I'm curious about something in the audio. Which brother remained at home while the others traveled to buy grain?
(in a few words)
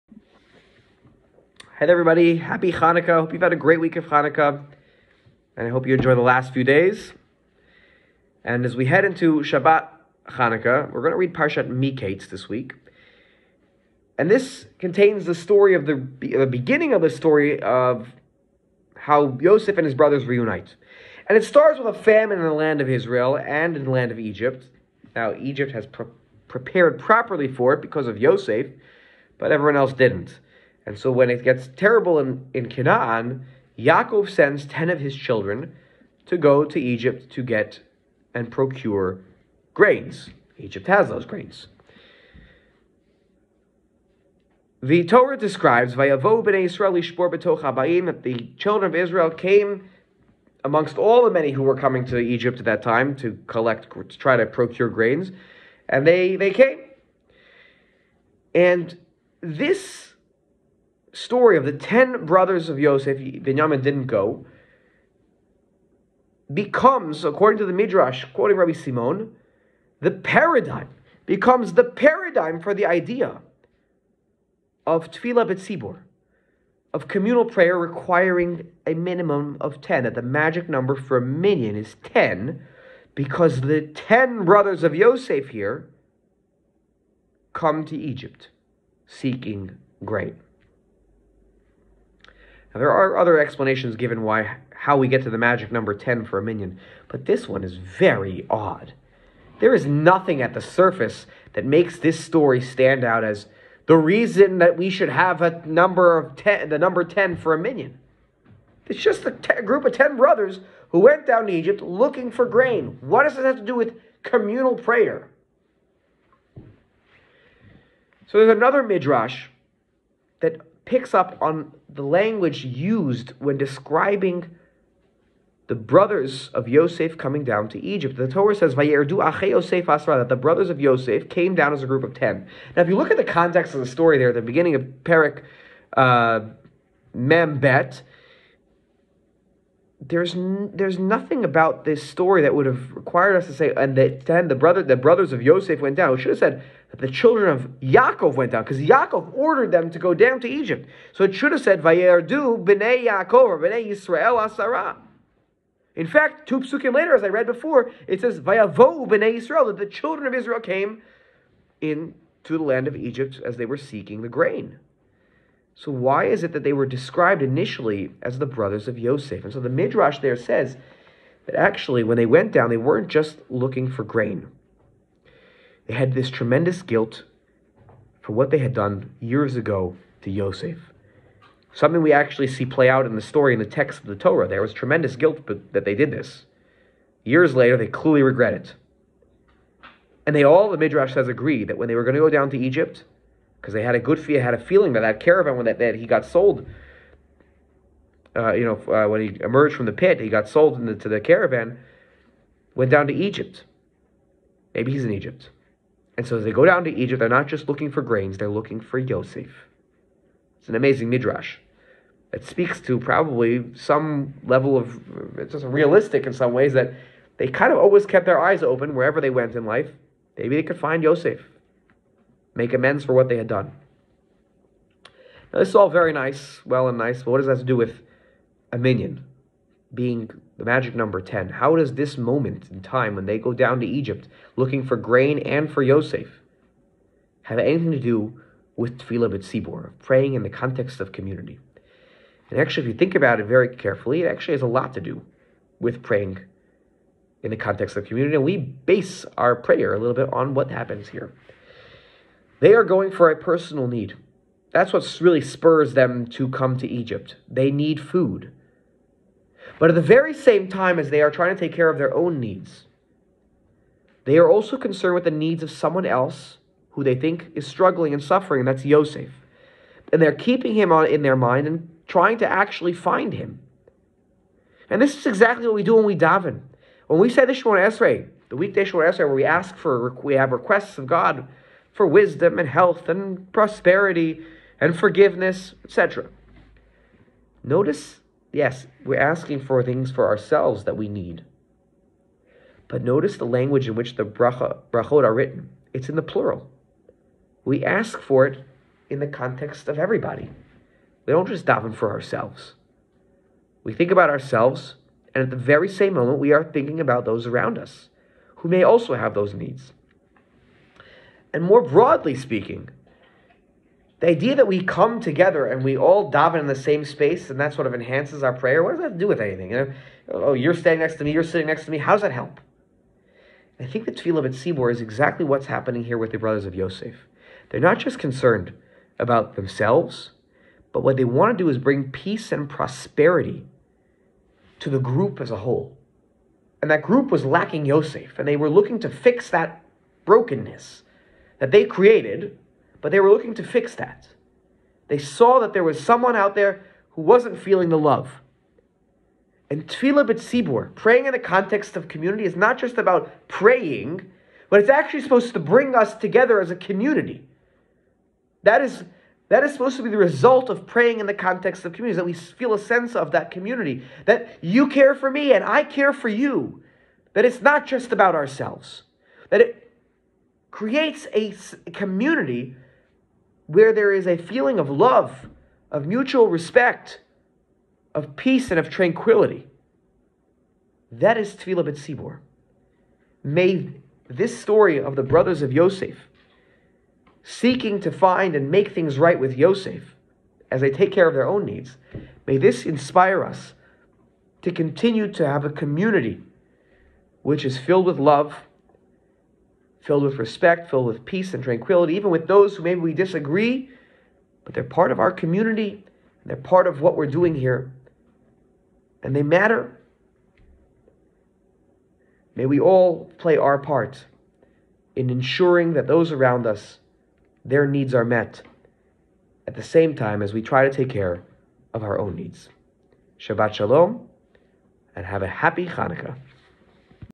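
Binyamin.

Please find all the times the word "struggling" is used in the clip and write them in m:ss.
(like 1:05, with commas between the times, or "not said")
4:27.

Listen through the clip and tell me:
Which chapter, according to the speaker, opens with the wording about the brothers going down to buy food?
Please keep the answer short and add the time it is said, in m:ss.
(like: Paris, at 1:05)
Mem Bet, at 2:17.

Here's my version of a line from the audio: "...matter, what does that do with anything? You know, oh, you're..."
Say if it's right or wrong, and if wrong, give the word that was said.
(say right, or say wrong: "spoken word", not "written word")
wrong: "prayer", not "matter".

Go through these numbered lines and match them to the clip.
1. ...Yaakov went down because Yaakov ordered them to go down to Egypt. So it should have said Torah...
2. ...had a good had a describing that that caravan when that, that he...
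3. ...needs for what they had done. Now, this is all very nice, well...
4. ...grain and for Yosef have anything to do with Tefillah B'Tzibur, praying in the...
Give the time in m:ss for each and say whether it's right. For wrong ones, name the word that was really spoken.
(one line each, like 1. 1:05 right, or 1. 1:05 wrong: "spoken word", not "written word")
1. 2:27 wrong: "Vayerdu", not "Torah"
2. 3:13 wrong: "feeling", not "describing"
3. 3:42 wrong: "amends", not "needs"
4. 3:54 right.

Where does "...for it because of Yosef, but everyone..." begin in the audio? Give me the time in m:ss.
0:27.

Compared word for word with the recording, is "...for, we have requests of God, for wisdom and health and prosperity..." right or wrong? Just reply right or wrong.
right.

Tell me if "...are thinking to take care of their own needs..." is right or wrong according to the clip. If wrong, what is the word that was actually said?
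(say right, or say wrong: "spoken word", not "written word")
wrong: "trying", not "thinking".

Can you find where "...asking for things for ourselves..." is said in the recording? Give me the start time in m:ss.
4:49.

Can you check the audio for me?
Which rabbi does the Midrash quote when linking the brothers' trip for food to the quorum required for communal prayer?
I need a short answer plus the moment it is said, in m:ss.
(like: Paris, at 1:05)
Rabbi Simon, at 1:08.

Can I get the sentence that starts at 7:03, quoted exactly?
Shabbat Shalom, and have a happy Hanukkah.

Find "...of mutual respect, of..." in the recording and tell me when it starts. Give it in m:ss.
6:15.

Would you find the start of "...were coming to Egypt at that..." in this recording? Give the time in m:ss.
0:51.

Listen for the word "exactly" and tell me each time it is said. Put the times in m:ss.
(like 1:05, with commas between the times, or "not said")
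4:35, 5:25.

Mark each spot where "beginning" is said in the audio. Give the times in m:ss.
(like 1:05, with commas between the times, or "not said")
0:16, 2:14.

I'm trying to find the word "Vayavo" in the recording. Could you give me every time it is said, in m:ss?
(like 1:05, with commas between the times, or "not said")
0:45, 2:38.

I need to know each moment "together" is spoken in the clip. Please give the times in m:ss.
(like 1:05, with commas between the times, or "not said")
5:15, 5:56.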